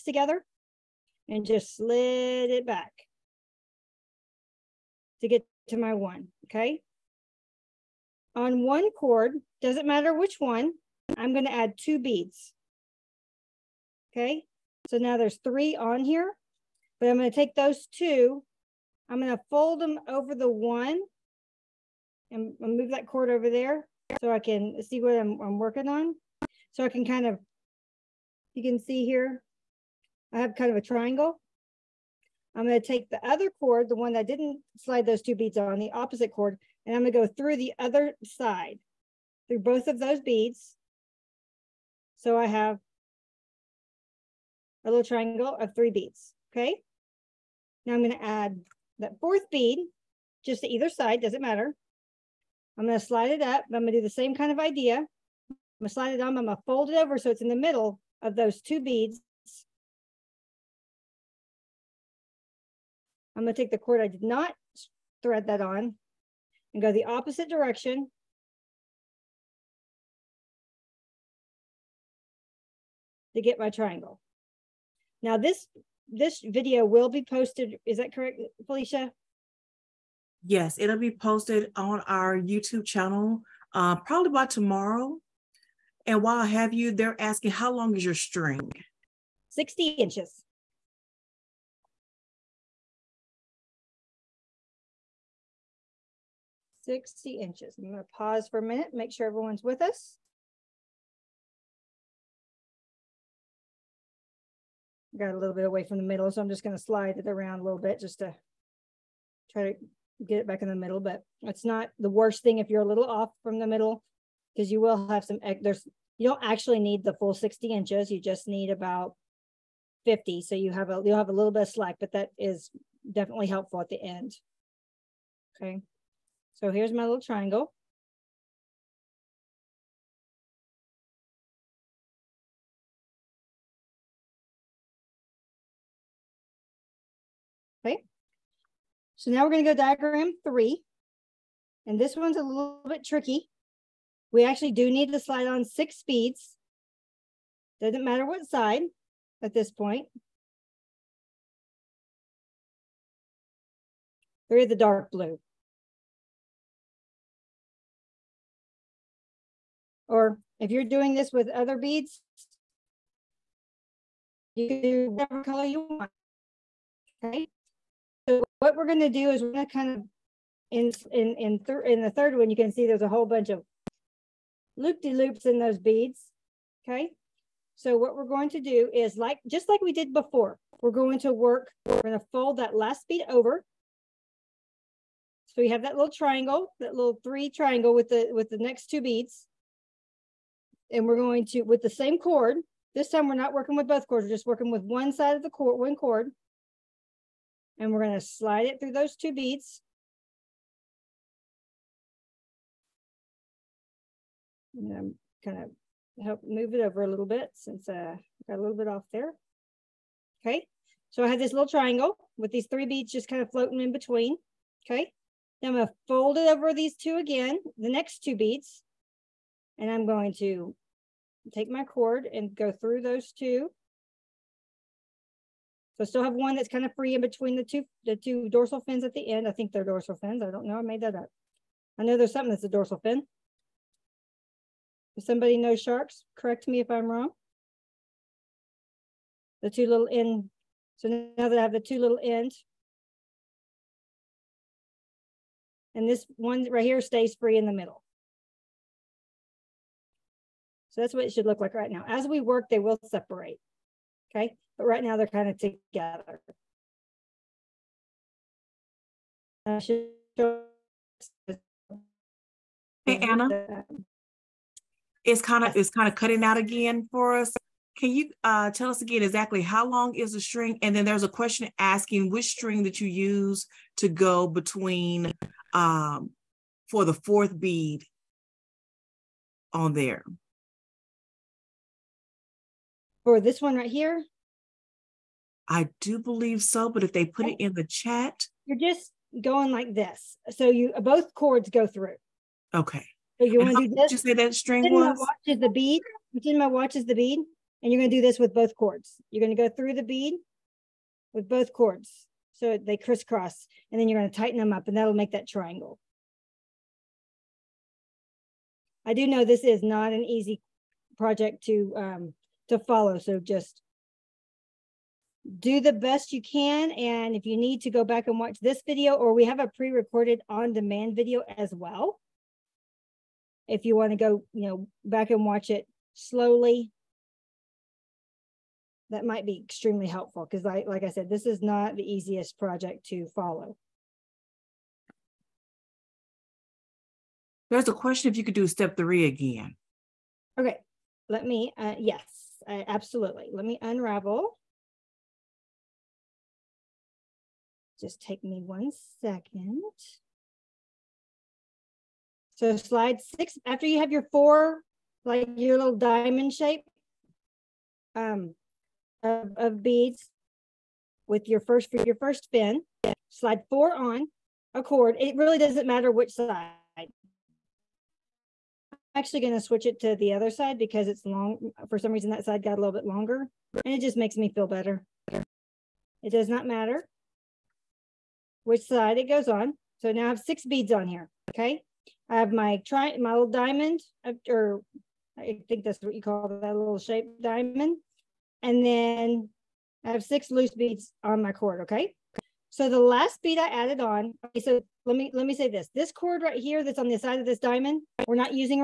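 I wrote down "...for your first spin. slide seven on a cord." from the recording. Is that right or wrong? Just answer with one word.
wrong.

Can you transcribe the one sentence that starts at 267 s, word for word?
Can you uh, tell us again exactly how long is the string?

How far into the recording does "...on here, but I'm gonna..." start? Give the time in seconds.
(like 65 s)
15 s.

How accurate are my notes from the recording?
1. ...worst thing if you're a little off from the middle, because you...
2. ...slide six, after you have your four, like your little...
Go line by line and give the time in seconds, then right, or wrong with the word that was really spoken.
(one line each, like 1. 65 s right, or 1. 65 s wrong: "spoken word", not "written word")
1. 112 s right
2. 352 s right.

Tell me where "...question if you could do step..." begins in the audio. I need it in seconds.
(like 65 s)
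337 s.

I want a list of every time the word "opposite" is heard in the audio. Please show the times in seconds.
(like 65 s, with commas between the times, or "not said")
35 s, 67 s.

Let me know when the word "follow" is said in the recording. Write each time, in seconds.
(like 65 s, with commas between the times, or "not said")
312 s, 333 s.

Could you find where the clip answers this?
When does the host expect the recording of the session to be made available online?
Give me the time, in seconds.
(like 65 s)
84 s.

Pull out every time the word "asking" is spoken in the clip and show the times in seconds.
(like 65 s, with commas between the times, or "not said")
87 s, 271 s.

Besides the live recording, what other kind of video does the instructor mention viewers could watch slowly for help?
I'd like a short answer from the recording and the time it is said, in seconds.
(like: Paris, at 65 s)
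on demand video, at 320 s.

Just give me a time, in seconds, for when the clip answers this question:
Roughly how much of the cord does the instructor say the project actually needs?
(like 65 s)
118 s.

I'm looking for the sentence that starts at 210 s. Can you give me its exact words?
Okay, so I have this little triangle with these three beads just kind of floating in between.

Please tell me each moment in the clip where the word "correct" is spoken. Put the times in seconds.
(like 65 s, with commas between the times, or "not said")
78 s, 236 s.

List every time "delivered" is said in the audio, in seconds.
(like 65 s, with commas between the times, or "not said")
not said.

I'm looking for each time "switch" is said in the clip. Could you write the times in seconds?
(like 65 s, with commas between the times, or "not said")
369 s.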